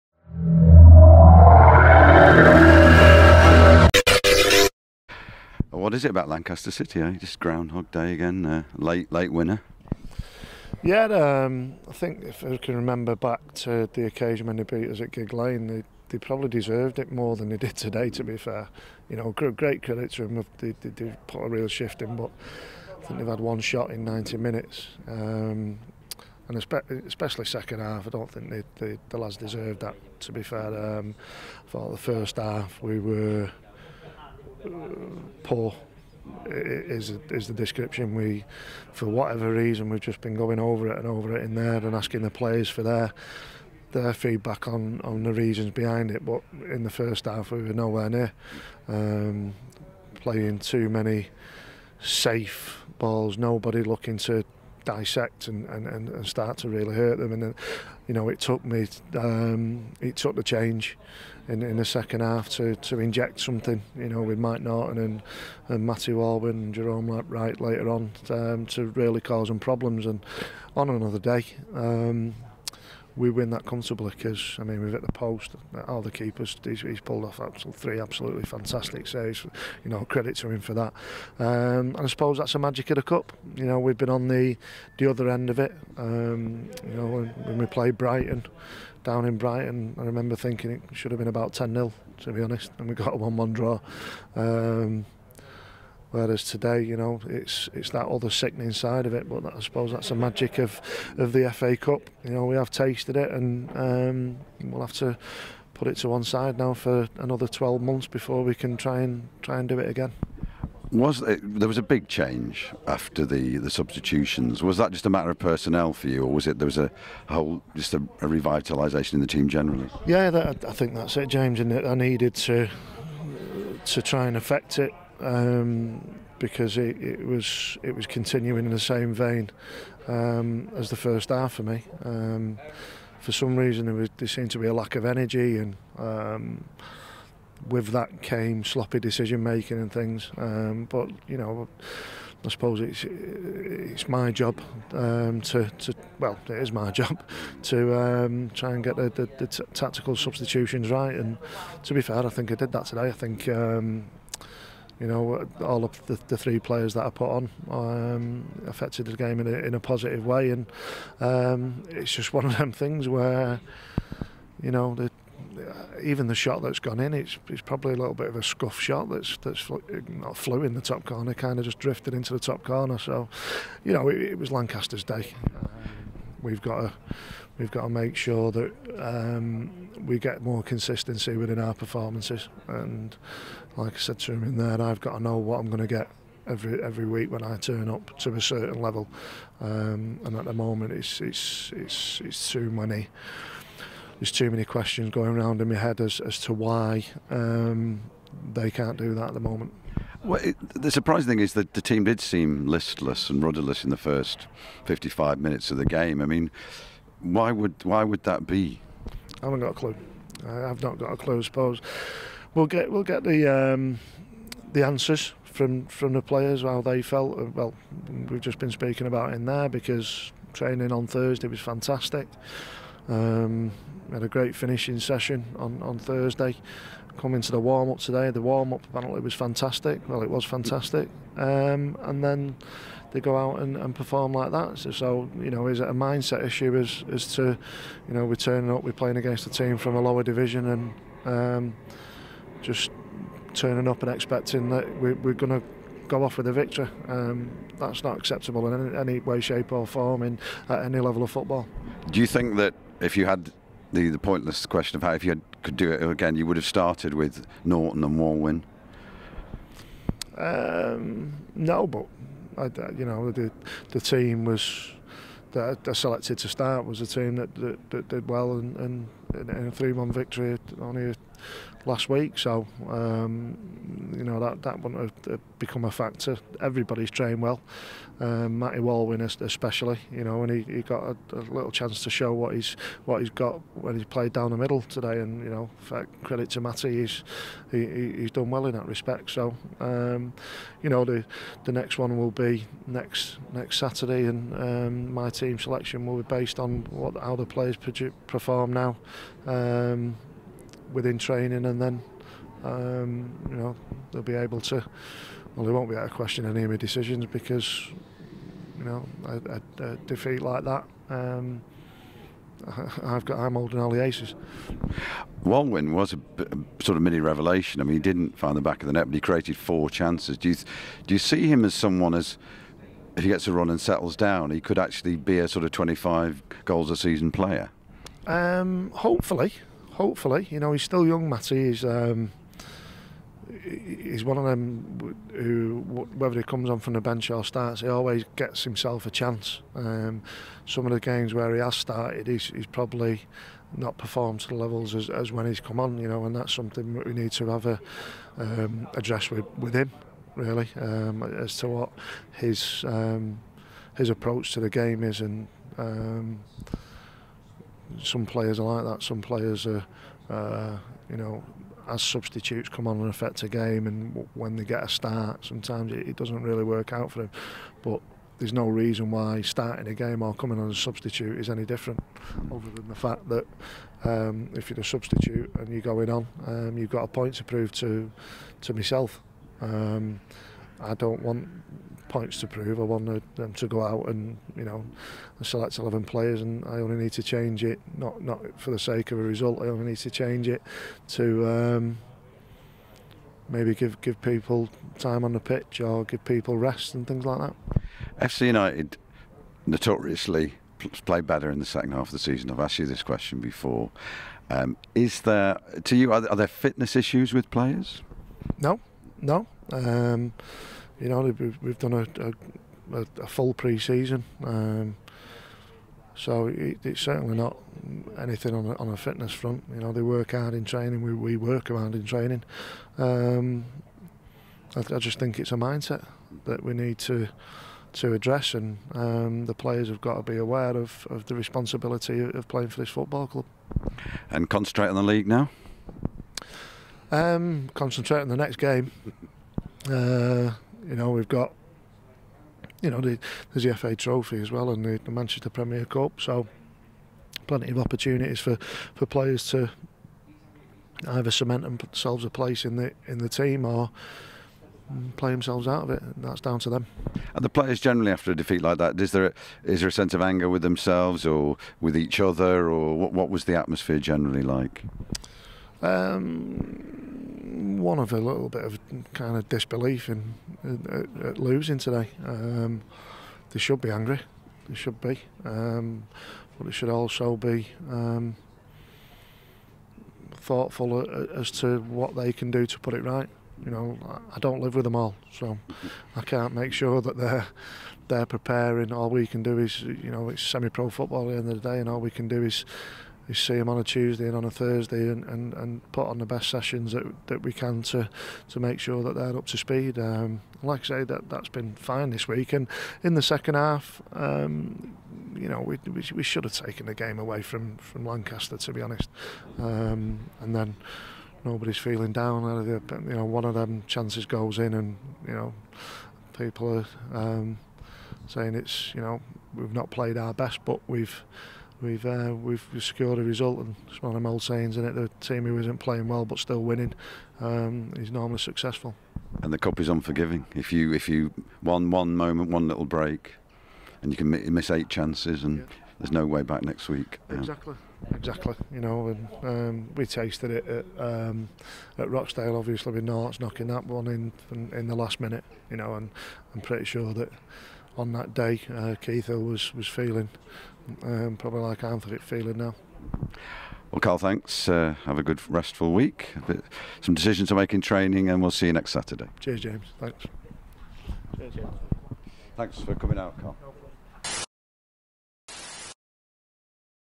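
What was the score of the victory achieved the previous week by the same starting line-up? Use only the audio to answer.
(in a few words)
3-1.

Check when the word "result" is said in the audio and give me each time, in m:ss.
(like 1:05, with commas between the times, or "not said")
6:29, 8:43.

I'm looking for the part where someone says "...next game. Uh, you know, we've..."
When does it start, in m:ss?
7:18.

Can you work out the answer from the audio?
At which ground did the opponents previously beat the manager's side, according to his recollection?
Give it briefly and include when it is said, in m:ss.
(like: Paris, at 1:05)
Gigg Lane, at 0:15.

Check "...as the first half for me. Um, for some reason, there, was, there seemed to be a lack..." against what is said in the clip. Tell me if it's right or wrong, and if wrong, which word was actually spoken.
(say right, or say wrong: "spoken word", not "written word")
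right.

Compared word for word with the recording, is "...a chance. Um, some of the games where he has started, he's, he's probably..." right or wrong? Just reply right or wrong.
right.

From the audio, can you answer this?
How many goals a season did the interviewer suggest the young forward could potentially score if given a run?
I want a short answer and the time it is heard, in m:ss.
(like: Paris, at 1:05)
25, at 5:25.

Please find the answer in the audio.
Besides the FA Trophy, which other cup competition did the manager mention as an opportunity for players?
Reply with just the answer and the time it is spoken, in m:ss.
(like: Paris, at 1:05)
Manchester Premier Cup, at 7:25.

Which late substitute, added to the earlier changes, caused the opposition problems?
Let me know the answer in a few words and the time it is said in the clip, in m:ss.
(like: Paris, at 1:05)
Jerome Wright, at 1:06.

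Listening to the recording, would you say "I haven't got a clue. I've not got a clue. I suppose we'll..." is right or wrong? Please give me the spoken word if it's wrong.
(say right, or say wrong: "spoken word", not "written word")
right.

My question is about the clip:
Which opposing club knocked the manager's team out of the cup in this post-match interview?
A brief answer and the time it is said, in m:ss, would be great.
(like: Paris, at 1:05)
Lancaster City, at 0:06.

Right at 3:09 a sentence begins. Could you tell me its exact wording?
Um, and at the moment, it's it's it's it's too many.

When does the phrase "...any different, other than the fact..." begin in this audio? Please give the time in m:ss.
6:11.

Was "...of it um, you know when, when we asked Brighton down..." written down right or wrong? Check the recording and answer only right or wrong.
wrong.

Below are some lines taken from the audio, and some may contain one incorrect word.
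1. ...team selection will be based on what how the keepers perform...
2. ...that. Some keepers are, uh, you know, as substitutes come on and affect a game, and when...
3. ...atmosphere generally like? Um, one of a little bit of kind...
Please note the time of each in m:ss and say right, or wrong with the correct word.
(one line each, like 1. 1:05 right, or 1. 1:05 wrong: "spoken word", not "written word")
1. 4:55 wrong: "players", not "keepers"
2. 5:58 wrong: "players", not "keepers"
3. 7:43 right.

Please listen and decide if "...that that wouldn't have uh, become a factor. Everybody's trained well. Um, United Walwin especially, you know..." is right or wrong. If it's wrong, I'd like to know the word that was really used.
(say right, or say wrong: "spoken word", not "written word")
wrong: "Matty", not "United".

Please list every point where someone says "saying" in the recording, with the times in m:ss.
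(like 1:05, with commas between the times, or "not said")
8:38, 8:44.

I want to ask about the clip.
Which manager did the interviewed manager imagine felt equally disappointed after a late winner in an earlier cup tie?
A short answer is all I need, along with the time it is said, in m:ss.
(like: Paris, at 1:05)
Keith Hill, at 9:08.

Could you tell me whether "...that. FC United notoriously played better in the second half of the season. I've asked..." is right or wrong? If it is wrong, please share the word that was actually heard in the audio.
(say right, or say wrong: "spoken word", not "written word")
right.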